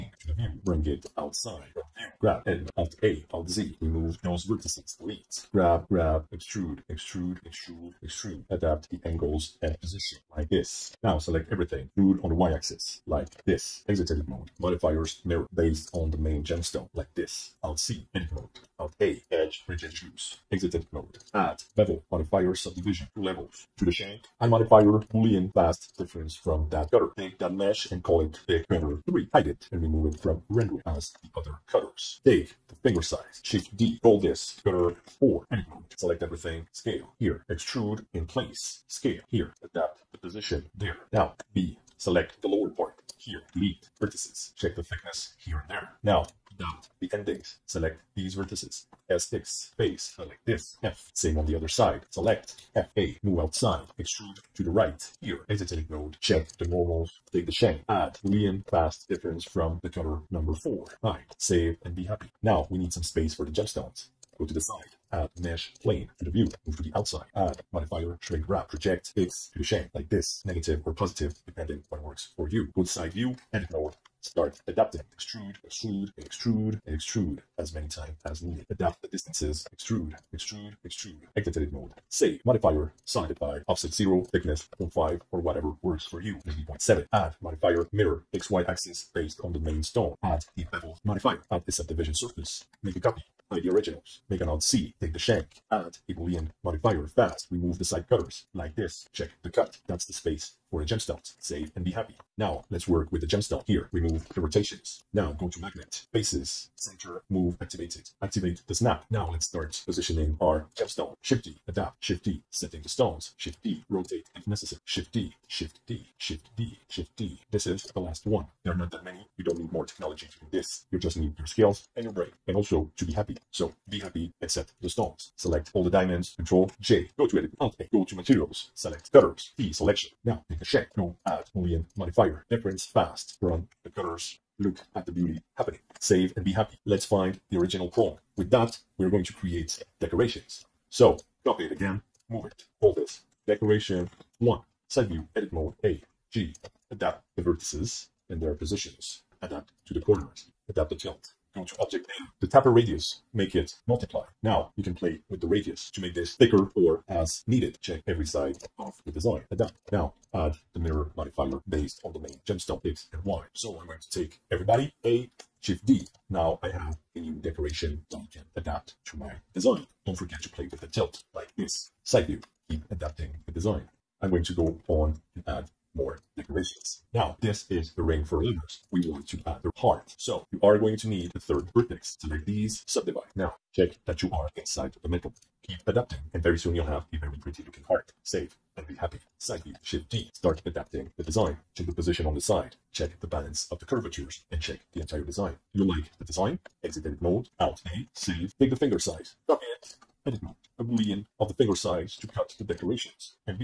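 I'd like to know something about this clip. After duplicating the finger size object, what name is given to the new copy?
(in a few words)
cutter 4.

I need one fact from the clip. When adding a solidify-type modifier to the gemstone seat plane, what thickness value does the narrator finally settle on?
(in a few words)
0.7.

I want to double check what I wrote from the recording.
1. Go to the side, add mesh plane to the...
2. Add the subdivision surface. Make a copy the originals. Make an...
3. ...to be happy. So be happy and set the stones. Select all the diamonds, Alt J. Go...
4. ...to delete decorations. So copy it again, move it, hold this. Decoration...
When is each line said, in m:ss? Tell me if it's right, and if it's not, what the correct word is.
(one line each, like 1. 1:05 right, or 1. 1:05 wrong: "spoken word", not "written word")
1. 1:04 right
2. 1:31 right
3. 2:02 wrong: "Control", not "Alt"
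4. 2:19 wrong: "create", not "delete".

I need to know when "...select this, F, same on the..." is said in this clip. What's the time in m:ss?
0:50.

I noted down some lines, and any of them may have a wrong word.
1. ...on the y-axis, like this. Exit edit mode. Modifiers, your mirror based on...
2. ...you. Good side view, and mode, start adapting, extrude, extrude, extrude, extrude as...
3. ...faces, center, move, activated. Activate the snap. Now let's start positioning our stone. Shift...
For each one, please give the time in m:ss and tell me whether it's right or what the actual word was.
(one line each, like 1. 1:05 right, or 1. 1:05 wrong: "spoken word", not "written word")
1. 0:12 right
2. 1:12 right
3. 1:46 wrong: "gemstone", not "stone".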